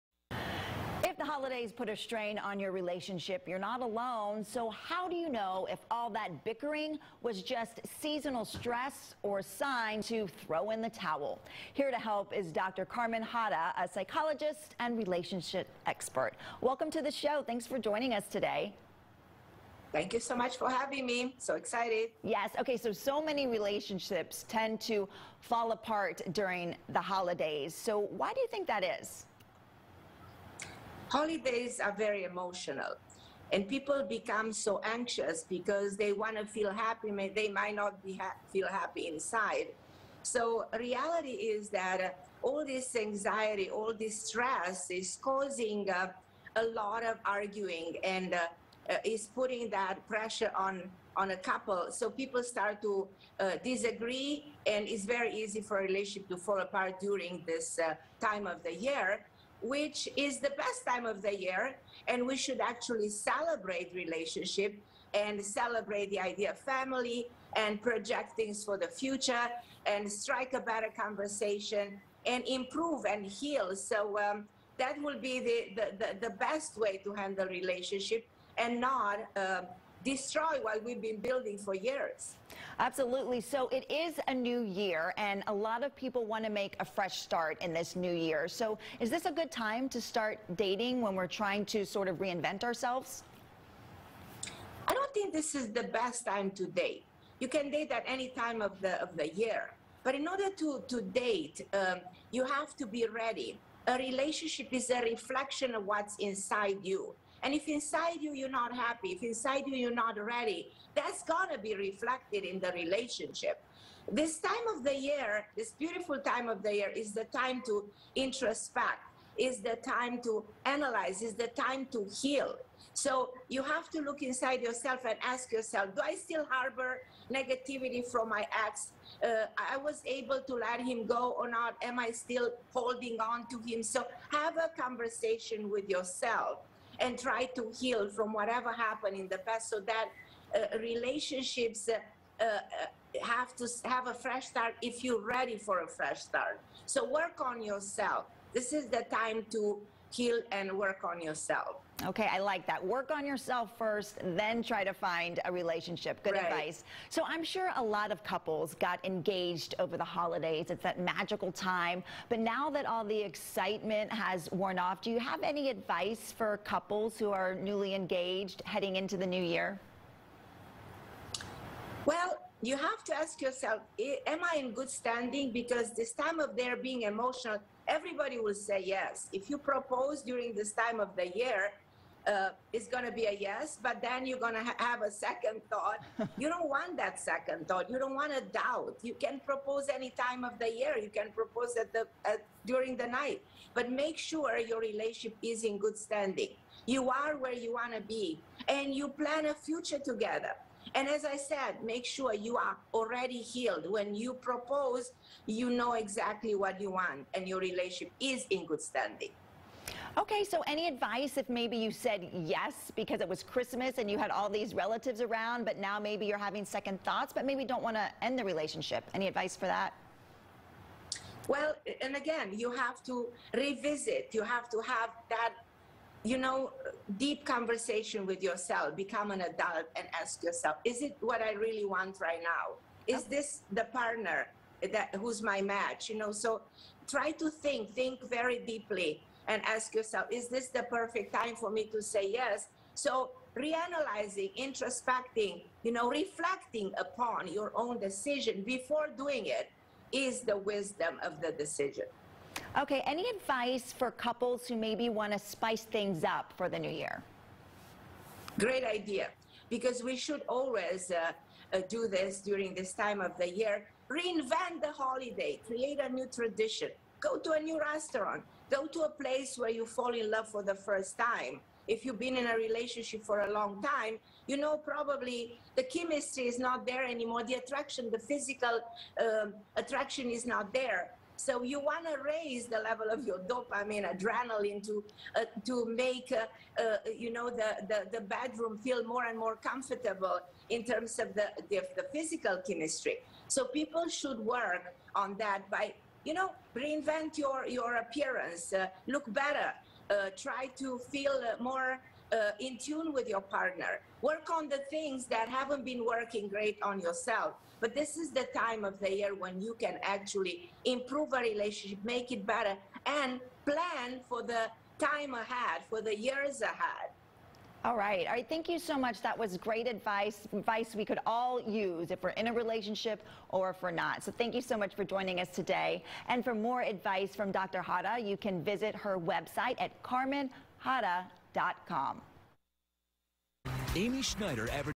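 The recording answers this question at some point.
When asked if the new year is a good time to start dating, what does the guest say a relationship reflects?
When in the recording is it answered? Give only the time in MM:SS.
01:45.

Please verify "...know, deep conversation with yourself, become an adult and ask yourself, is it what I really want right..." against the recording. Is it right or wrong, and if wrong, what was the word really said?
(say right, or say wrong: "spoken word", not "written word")
right.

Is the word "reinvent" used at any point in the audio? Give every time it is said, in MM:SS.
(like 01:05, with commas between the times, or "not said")
01:32, 04:24, 04:56.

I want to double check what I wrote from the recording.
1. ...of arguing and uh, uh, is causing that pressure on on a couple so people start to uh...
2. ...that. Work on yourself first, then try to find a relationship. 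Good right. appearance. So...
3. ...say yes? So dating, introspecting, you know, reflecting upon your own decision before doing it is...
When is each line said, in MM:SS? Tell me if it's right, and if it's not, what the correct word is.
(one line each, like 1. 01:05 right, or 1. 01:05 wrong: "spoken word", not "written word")
1. 00:47 wrong: "putting", not "causing"
2. 02:32 wrong: "advice", not "appearance"
3. 04:02 wrong: "reanalyzing", not "dating".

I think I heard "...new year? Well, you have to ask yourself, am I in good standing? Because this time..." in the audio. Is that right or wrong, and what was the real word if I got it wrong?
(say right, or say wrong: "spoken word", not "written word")
right.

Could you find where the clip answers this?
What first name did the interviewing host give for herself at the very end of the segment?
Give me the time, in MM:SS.
05:33.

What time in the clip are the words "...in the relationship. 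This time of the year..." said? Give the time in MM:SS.
01:52.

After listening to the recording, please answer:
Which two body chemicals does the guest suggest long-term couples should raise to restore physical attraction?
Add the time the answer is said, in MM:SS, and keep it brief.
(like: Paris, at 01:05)
dopamine, adrenaline, at 04:43.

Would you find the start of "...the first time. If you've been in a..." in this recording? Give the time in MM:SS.
04:30.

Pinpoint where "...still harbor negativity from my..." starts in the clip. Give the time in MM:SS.
02:06.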